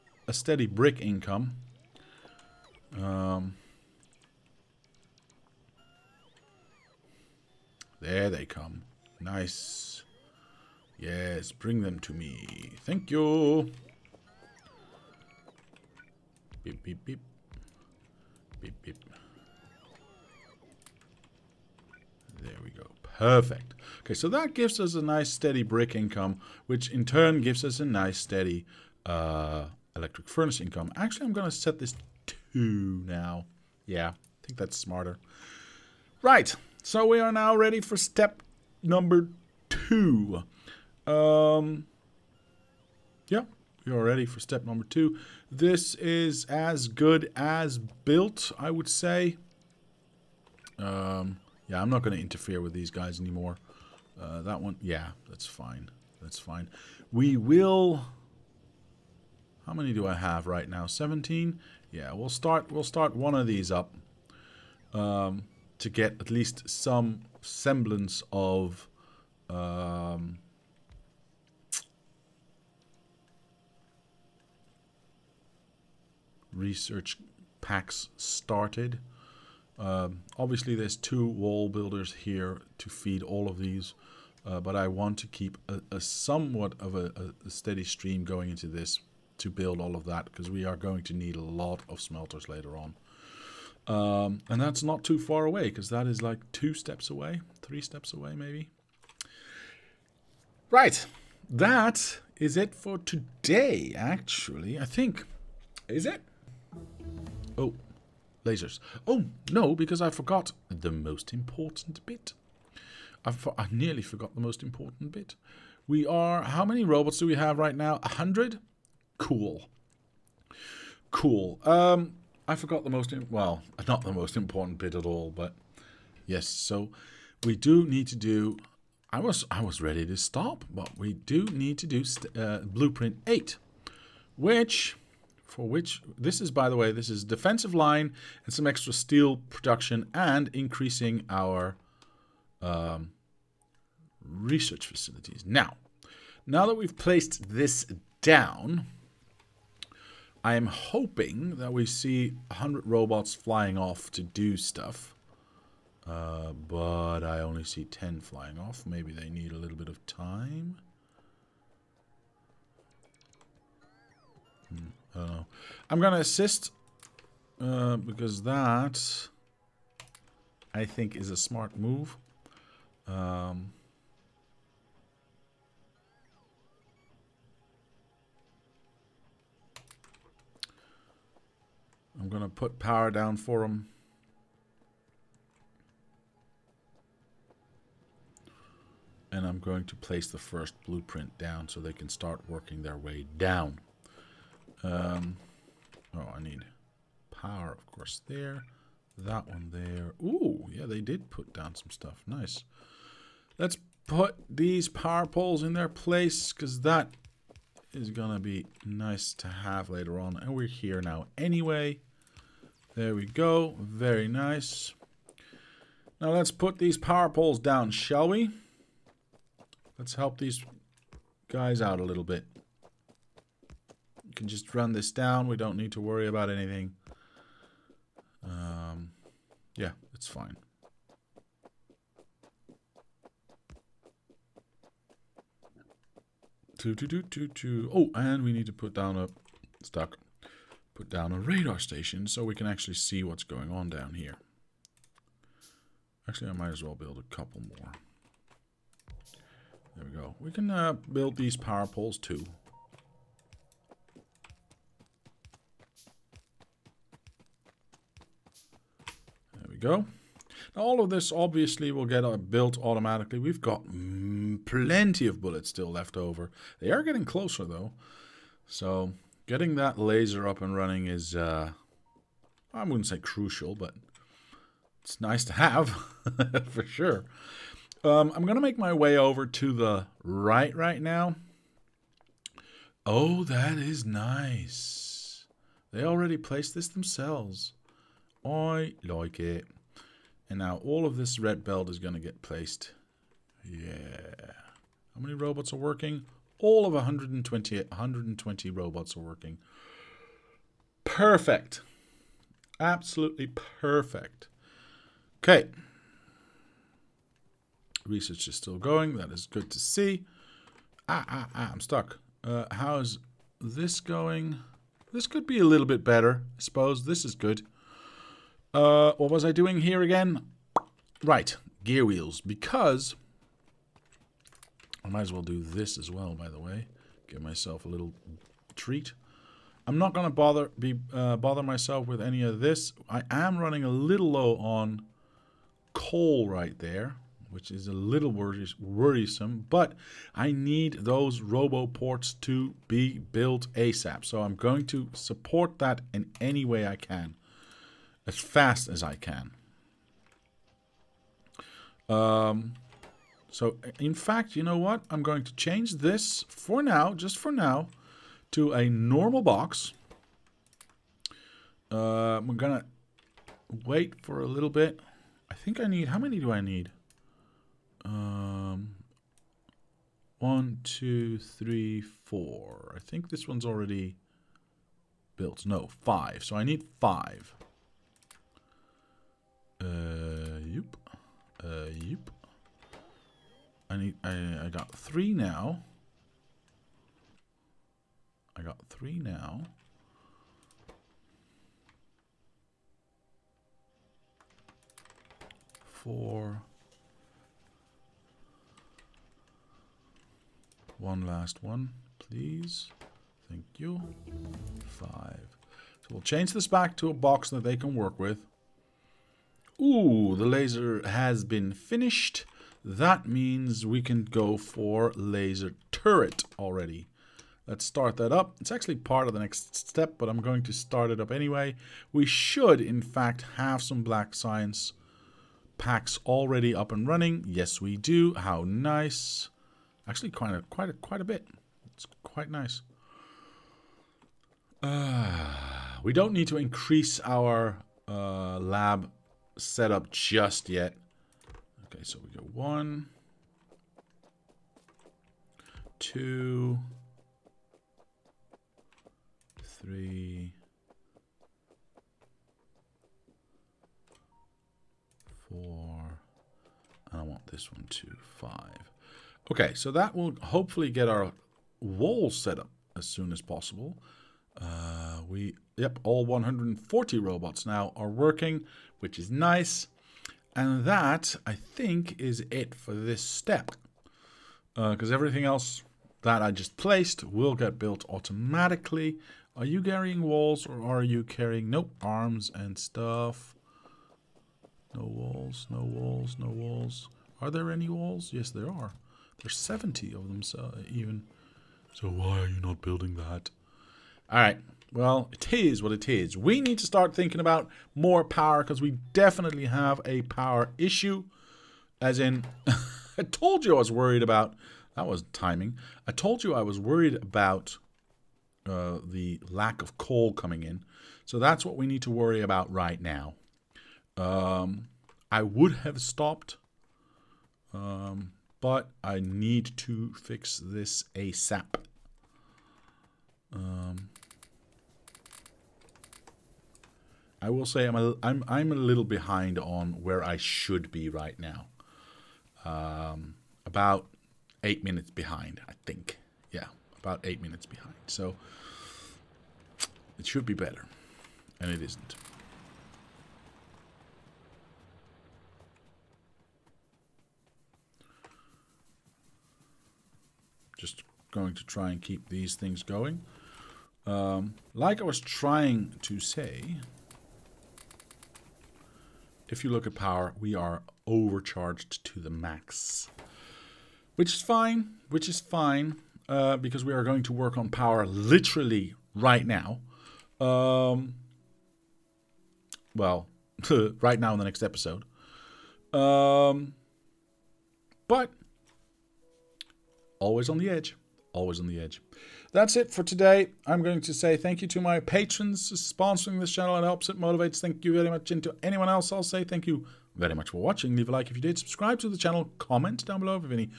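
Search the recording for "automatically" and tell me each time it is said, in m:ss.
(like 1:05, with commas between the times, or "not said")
4:22, 7:58.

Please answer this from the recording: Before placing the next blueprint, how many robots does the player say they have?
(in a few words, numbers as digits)
100.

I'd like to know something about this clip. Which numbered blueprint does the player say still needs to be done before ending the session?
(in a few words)
Blueprint 8.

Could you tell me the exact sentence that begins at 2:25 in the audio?
Now, now that we've placed this down, I am hoping that we see 100 robots flying off to do stuff.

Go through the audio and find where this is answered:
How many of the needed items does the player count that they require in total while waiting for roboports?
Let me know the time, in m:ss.
6:16.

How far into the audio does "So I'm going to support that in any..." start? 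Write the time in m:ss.
5:44.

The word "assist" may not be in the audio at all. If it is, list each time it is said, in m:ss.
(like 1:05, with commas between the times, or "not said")
2:46.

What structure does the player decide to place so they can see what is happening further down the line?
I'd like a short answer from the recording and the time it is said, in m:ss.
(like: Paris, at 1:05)
Radar station, at 4:01.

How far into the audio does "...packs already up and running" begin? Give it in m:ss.
7:05.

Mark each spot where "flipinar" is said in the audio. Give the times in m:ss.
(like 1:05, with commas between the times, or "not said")
not said.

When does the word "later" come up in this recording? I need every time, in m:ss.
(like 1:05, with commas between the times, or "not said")
1:32, 3:29.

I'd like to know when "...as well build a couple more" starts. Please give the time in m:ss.
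4:06.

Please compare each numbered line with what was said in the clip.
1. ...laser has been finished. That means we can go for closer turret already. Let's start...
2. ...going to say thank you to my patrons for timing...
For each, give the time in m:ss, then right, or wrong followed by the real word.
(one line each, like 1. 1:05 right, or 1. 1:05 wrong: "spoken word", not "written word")
1. 6:50 wrong: "laser", not "closer"
2. 9:43 wrong: "sponsoring", not "timing".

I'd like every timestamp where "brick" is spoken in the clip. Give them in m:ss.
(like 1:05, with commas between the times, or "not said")
0:00, 0:25.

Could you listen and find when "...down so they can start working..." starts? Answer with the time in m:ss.
3:11.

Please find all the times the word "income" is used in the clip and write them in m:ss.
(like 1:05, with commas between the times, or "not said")
0:01, 0:25, 0:30.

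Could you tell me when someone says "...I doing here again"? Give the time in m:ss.
5:19.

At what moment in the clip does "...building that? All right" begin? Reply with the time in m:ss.
8:12.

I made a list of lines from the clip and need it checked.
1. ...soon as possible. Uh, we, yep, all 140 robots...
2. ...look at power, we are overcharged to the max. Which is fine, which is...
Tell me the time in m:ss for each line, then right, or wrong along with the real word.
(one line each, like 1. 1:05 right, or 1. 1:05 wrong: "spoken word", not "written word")
1. 7:43 right
2. 9:19 right.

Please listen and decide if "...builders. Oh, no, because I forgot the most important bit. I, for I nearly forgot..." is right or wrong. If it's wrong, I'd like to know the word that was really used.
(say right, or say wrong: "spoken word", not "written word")
wrong: "lasers", not "builders".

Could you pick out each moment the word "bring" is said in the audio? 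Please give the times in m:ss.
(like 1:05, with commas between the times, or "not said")
0:11.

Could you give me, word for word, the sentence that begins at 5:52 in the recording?
Um, so in fact, you know what?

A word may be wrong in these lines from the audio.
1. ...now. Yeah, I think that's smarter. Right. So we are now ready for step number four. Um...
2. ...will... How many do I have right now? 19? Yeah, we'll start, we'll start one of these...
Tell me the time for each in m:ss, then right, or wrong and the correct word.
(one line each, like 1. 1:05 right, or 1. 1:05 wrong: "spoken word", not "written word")
1. 0:33 wrong: "two", not "four"
2. 0:57 wrong: "17", not "19".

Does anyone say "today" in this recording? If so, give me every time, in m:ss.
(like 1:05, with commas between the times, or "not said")
1:42, 9:43.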